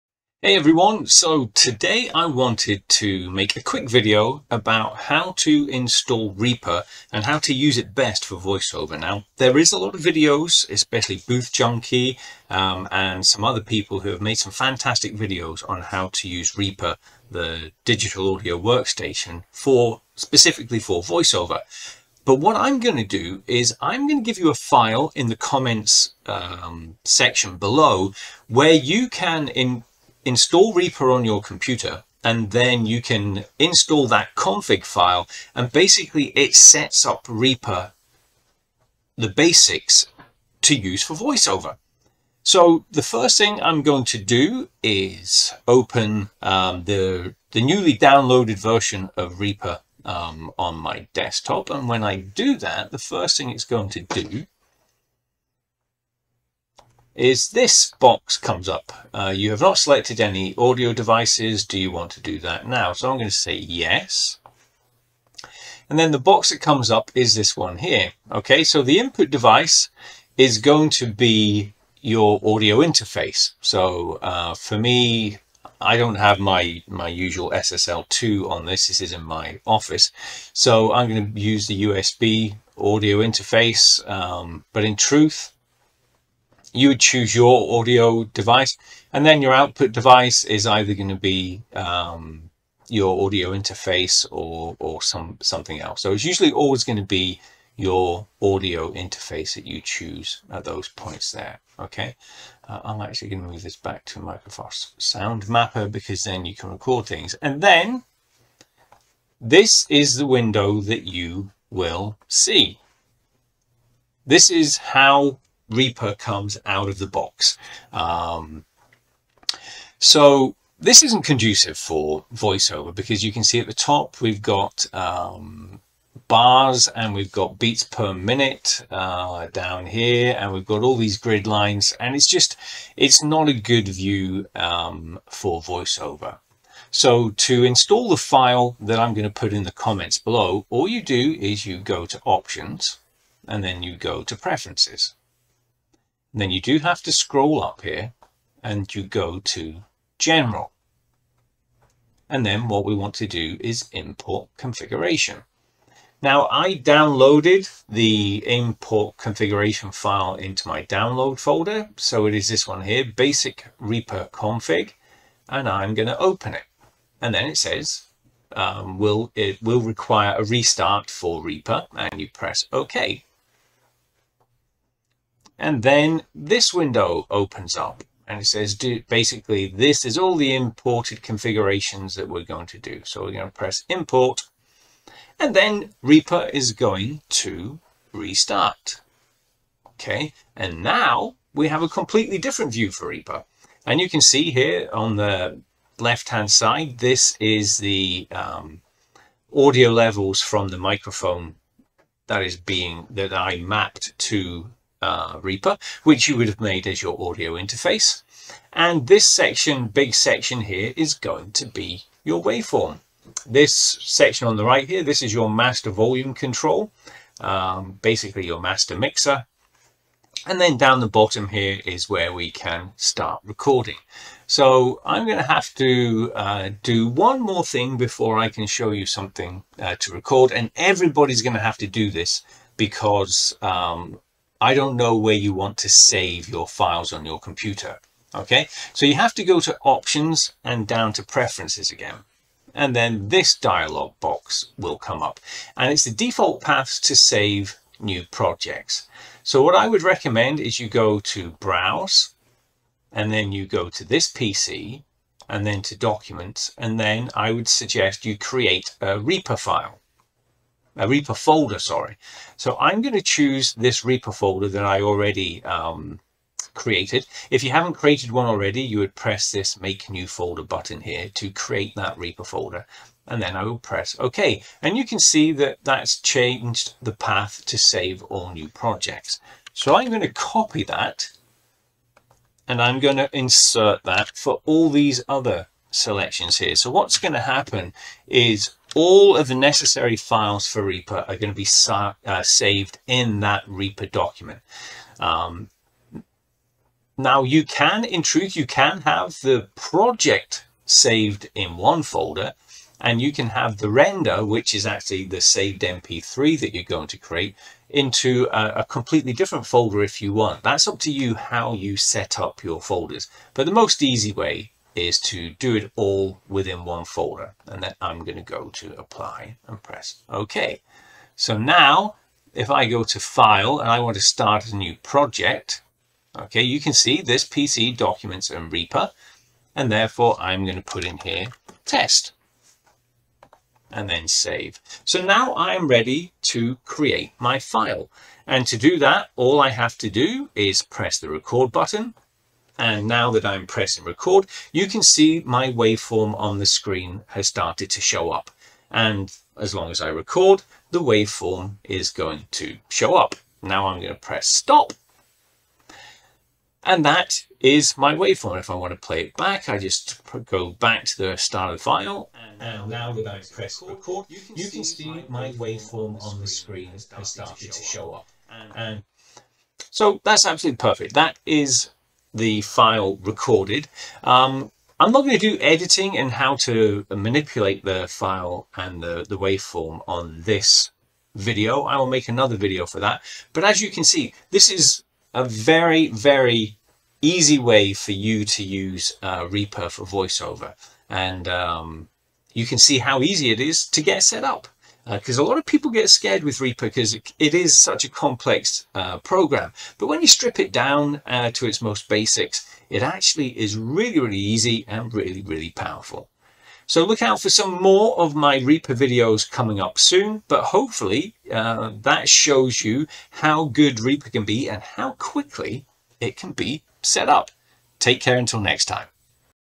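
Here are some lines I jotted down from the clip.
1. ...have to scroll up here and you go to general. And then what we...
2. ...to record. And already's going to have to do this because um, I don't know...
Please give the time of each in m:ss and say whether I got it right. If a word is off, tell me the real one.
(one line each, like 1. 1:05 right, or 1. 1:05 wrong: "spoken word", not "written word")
1. 2:26 right
2. 3:49 wrong: "everybody", not "already".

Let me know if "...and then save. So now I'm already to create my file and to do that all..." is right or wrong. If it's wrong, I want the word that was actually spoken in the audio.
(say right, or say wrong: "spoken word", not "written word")
wrong: "ready", not "already".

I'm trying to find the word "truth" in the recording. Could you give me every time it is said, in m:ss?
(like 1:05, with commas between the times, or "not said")
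1:24, 4:58.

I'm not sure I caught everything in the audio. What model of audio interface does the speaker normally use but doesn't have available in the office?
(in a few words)
SSL2.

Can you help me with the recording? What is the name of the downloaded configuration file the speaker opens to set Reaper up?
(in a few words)
basic Reaper config.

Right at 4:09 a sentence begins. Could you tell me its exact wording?
So what I would recommend is you go to browse and then you go to this PC and then to documents.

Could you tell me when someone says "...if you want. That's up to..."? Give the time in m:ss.
5:10.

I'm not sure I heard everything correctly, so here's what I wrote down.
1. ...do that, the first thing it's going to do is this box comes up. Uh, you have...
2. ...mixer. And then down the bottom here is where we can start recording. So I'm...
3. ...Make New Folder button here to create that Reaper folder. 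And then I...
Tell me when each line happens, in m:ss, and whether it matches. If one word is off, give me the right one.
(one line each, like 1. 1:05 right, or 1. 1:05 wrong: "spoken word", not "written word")
1. 0:52 right
2. 3:38 right
3. 4:29 right.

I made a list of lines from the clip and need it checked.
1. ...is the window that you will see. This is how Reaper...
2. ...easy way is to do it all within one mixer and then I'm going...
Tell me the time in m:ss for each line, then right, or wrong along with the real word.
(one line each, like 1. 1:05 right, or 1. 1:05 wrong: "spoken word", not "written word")
1. 1:49 right
2. 5:14 wrong: "folder", not "mixer".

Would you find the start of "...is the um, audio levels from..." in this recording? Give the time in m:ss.
3:17.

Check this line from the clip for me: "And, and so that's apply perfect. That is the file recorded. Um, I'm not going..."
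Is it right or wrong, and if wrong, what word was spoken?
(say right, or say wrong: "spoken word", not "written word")
wrong: "absolutely", not "apply".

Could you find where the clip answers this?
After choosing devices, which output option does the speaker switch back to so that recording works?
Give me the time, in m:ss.
1:44.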